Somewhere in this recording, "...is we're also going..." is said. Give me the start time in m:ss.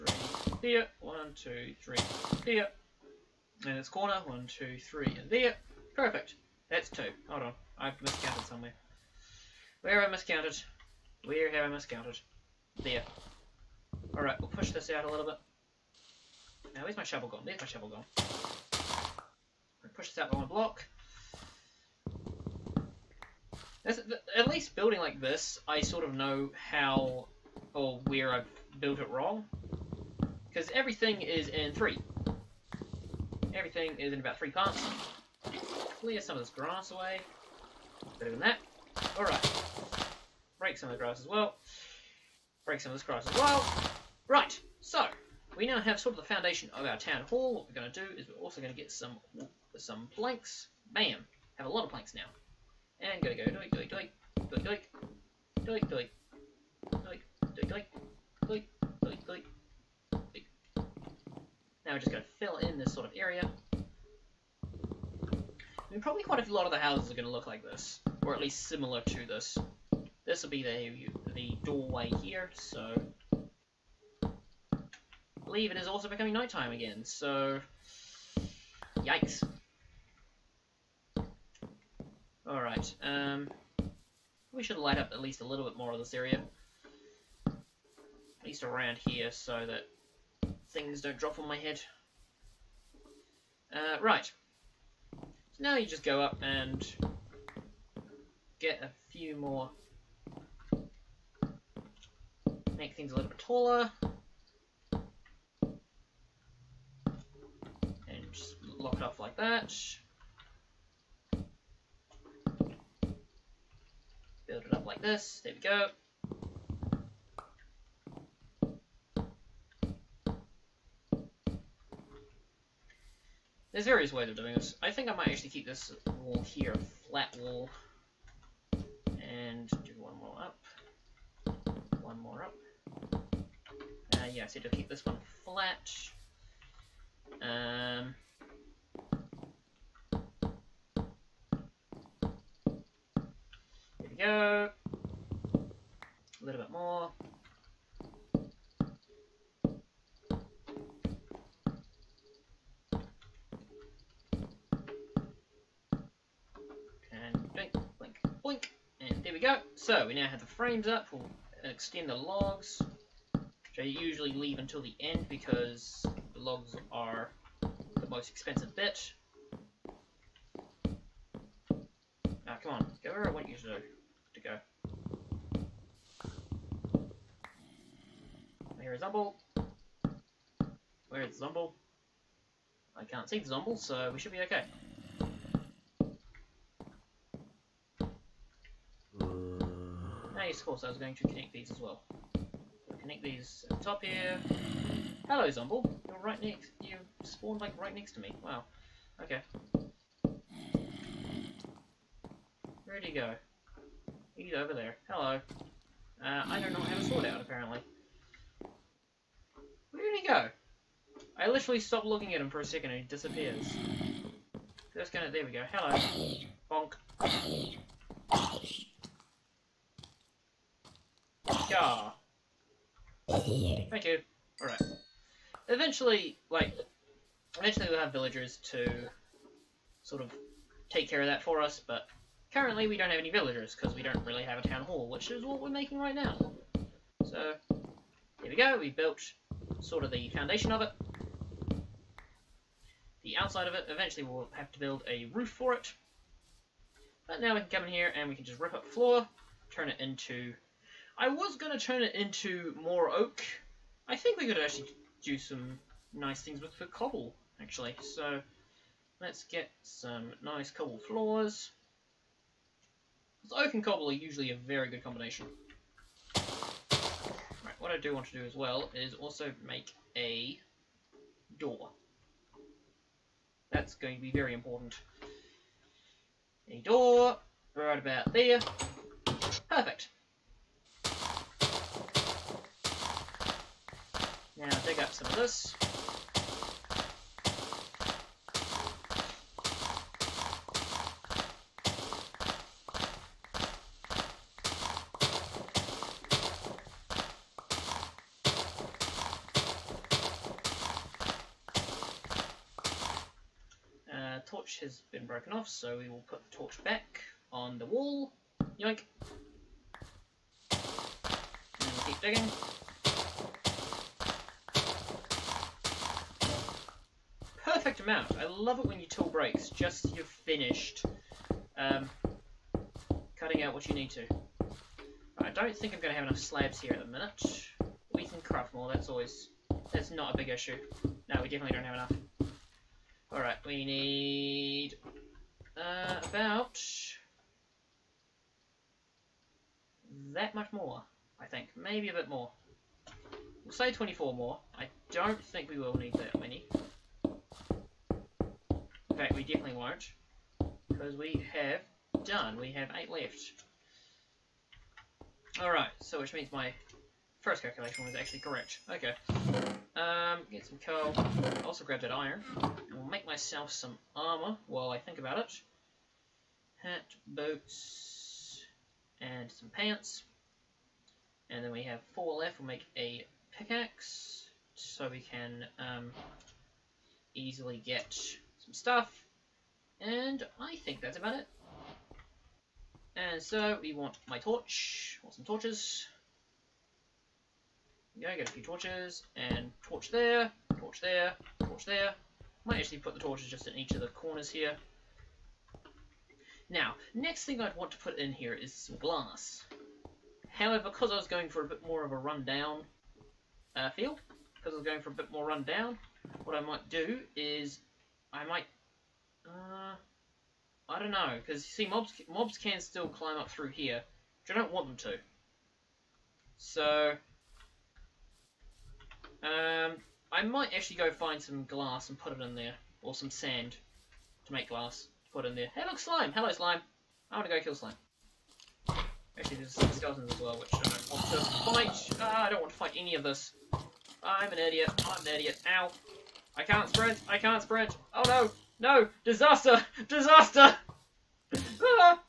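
0:48.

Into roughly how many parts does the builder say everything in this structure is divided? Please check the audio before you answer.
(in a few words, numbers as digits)
3.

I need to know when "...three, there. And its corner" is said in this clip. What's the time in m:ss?
0:01.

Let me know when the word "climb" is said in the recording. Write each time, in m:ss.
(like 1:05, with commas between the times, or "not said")
6:53.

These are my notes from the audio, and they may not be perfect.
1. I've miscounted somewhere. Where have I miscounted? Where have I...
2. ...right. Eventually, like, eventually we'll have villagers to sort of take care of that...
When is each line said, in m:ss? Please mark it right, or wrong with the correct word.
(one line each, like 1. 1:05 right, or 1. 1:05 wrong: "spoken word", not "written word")
1. 0:07 right
2. 3:44 right.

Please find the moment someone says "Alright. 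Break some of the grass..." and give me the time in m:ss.
0:39.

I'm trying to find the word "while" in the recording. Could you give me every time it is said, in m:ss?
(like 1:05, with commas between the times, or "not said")
6:04.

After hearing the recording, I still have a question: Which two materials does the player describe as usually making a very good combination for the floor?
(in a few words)
Oak and cobble.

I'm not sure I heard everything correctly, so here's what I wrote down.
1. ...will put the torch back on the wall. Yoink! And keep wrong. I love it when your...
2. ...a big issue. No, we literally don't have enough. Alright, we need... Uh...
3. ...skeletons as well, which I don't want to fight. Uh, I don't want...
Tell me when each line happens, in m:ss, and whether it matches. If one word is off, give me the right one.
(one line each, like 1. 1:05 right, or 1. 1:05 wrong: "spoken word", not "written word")
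1. 5:06 wrong: "digging", not "wrong"
2. 5:30 wrong: "definitely", not "literally"
3. 7:09 right.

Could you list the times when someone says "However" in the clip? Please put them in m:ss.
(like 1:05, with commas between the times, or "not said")
6:40.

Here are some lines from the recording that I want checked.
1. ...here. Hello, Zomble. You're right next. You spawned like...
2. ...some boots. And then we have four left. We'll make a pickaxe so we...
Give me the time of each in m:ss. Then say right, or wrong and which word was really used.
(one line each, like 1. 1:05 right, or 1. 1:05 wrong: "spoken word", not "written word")
1. 3:14 right
2. 6:09 wrong: "pants", not "boots".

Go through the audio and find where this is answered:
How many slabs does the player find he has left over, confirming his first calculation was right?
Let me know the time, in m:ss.
5:52.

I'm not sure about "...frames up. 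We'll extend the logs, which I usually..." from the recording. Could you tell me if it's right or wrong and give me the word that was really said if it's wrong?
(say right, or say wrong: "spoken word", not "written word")
right.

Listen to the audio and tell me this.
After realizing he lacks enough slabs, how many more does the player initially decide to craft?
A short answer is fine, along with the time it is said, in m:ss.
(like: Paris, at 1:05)
24, at 5:43.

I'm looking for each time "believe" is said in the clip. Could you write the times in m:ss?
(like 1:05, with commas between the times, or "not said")
1:15.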